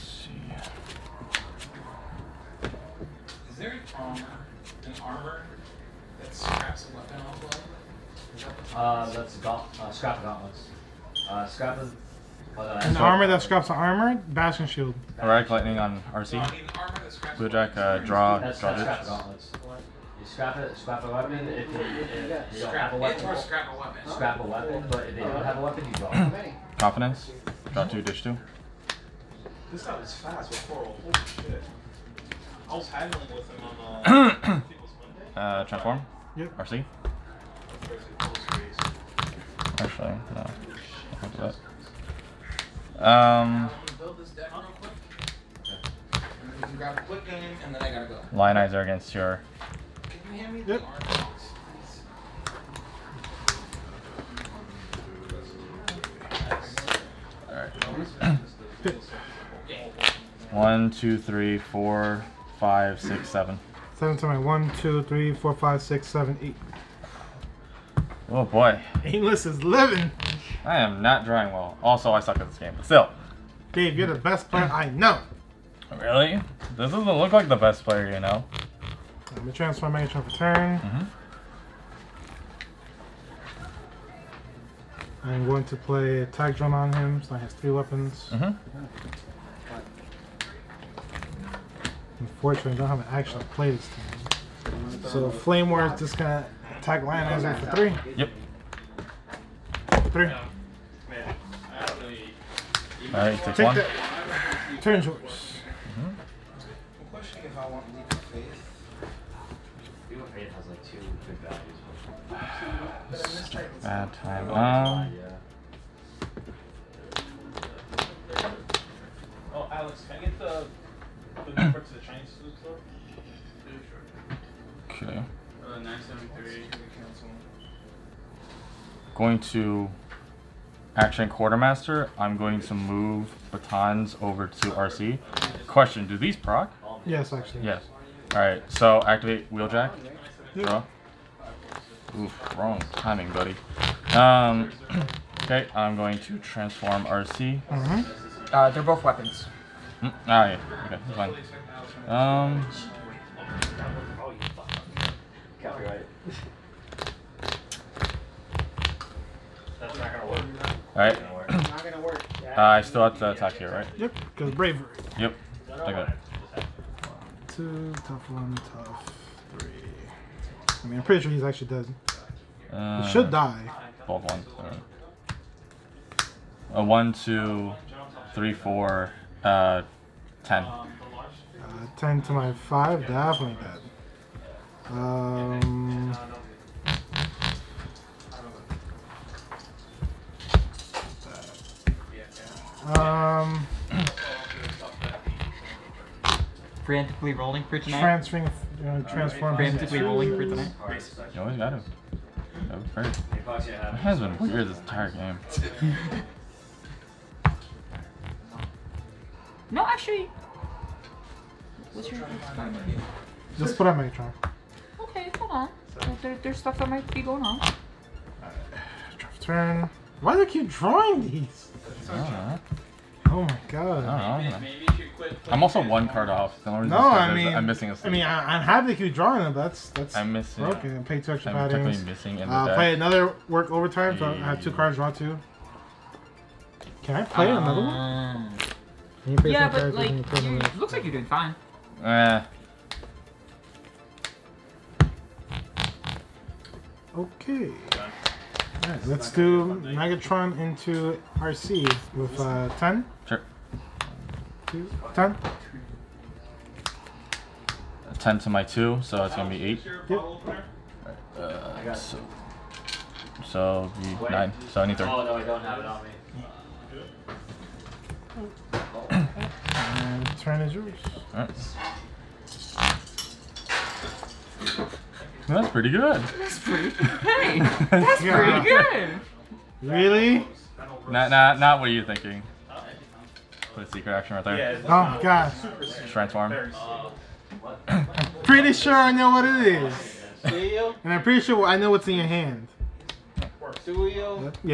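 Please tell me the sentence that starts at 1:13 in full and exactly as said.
Dave, you're the best player I know.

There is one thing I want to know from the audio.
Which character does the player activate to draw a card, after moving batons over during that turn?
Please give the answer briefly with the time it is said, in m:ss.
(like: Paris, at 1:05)
Wheeljack, at 2:19.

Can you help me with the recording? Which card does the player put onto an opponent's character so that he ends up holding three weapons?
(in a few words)
Attack Drone.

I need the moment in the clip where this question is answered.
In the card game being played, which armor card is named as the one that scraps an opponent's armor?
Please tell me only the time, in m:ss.
0:14.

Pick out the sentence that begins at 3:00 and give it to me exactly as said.
Uh, ten to my five, definitely dead.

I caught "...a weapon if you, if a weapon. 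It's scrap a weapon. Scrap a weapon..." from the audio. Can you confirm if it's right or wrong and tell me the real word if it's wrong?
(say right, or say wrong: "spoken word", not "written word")
right.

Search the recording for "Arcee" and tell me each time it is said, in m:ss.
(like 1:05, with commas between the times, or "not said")
0:16, 0:36, 2:14, 4:11.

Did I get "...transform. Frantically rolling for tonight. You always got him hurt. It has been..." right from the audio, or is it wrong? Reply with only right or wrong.
right.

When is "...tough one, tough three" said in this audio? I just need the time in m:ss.
2:48.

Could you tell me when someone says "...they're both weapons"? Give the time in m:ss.
2:28.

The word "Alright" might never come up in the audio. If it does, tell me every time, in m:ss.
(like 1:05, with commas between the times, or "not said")
1:43, 2:40.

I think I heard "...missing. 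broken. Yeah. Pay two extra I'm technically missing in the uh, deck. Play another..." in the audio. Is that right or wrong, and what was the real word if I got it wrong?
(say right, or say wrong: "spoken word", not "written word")
right.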